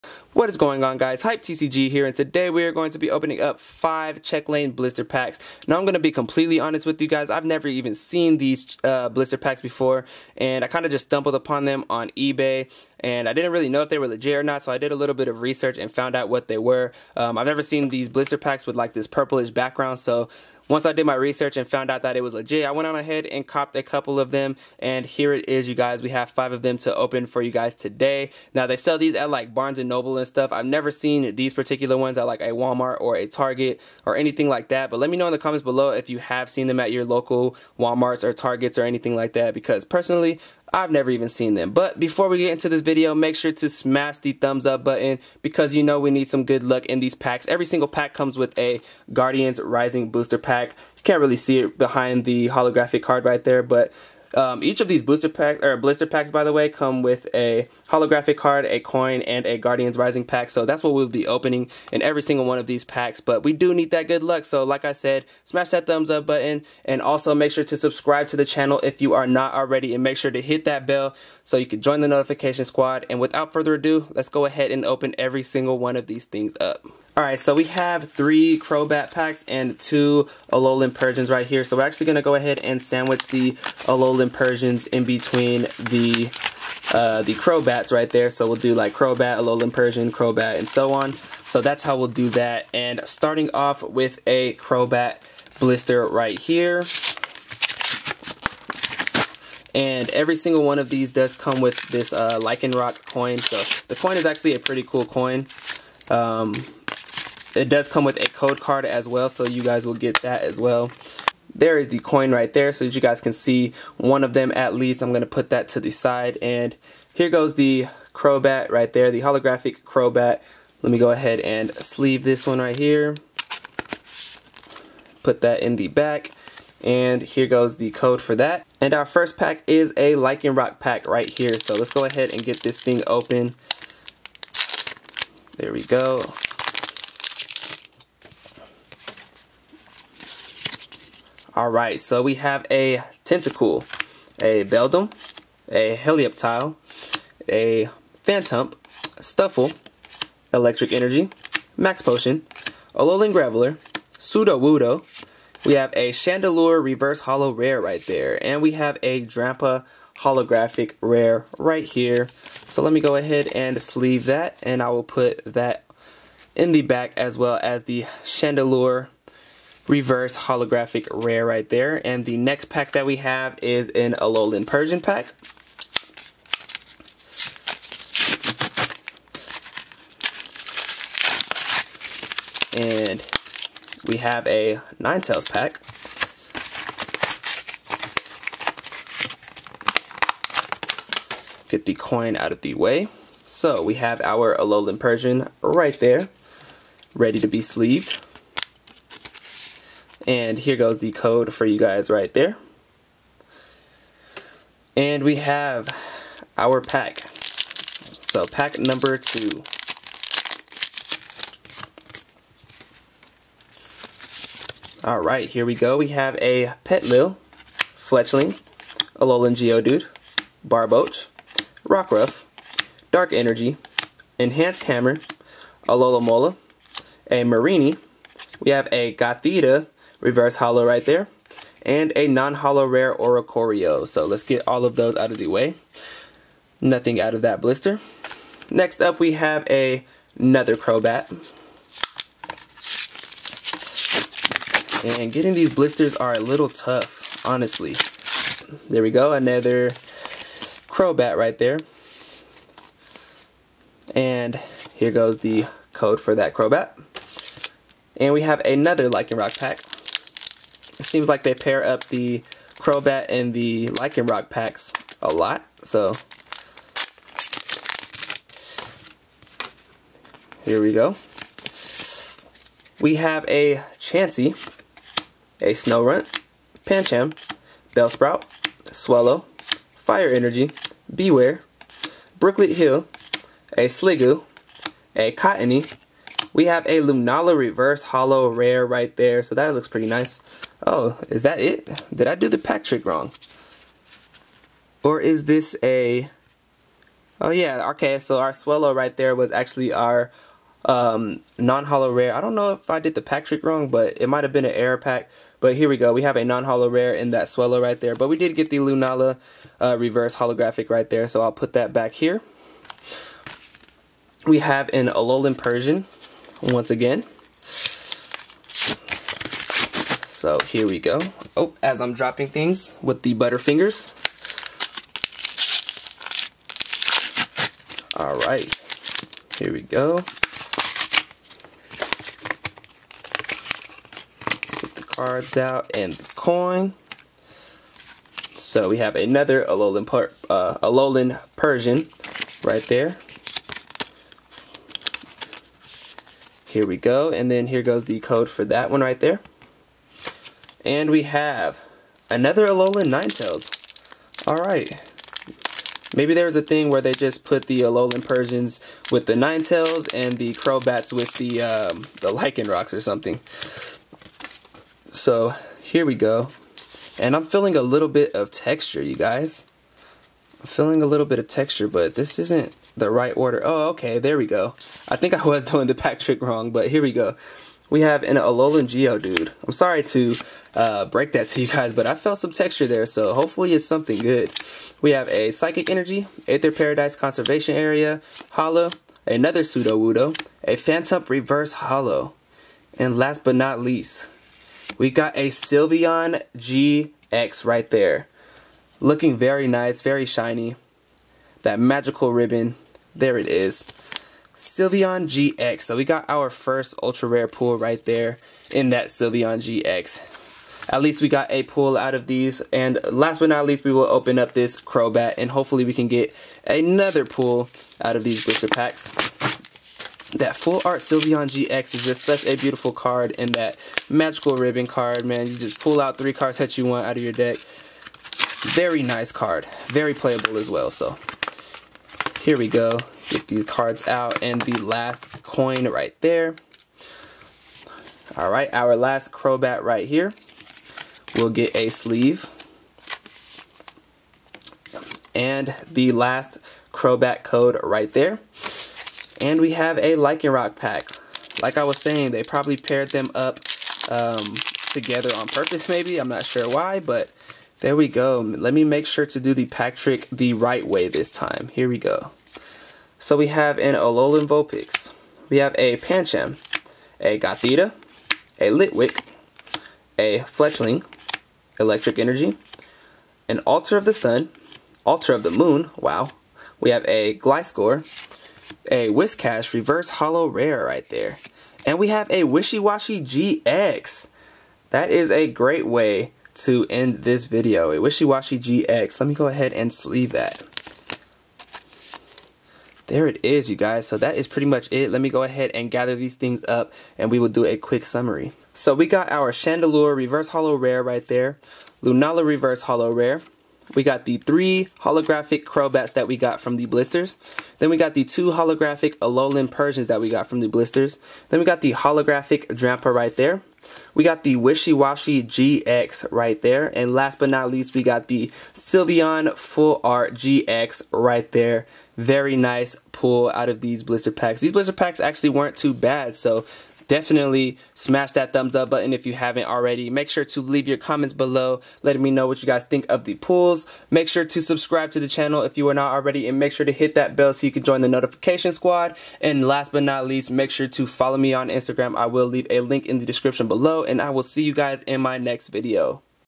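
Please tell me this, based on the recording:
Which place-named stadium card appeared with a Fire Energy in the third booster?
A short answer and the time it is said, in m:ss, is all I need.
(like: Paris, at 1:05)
Brooklet Hill, at 4:42.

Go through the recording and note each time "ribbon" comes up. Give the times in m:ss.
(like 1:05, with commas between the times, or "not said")
6:42, 7:04.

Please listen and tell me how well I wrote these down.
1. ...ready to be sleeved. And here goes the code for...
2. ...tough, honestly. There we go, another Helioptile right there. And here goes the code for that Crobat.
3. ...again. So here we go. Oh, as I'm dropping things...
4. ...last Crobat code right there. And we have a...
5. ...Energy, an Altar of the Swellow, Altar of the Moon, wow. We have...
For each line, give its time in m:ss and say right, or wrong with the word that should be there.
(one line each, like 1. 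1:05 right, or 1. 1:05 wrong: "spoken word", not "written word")
1. 3:17 right
2. 4:06 wrong: "Crobat", not "Helioptile"
3. 5:16 right
4. 7:26 right
5. 7:52 wrong: "Sun", not "Swellow".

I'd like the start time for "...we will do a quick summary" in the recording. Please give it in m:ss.
8:17.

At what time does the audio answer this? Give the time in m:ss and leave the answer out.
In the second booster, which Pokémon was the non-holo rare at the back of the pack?
3:53.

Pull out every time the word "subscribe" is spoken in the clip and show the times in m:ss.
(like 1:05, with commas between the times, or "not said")
1:07, 8:54.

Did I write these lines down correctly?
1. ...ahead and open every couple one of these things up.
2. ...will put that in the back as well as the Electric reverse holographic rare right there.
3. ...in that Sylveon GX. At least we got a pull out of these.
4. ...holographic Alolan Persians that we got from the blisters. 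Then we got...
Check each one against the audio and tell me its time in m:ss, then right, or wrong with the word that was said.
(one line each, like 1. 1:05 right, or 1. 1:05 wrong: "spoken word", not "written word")
1. 1:14 wrong: "single", not "couple"
2. 2:44 wrong: "Chandelure", not "Electric"
3. 6:48 right
4. 8:28 right.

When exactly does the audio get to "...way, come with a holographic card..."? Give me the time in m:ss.
0:56.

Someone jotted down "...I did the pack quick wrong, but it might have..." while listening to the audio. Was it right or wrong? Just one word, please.
wrong.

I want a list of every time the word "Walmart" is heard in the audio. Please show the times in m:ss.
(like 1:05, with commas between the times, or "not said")
0:32, 0:37.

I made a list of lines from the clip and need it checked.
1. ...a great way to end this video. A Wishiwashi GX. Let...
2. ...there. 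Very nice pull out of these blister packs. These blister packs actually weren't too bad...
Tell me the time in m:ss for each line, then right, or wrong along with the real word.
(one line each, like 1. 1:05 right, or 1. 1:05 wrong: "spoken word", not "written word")
1. 8:05 right
2. 8:41 right.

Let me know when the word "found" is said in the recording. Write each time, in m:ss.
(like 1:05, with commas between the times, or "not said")
0:15, 0:21.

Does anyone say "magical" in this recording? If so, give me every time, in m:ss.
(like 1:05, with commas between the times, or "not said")
6:41, 7:04.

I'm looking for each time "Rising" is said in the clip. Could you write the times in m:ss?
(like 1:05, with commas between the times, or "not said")
0:49, 0:59.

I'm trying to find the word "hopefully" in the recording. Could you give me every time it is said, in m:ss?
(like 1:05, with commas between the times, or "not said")
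6:23, 6:55.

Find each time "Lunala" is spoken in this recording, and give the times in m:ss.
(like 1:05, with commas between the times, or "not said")
4:46, 5:08, 8:22.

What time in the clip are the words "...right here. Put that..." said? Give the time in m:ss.
2:02.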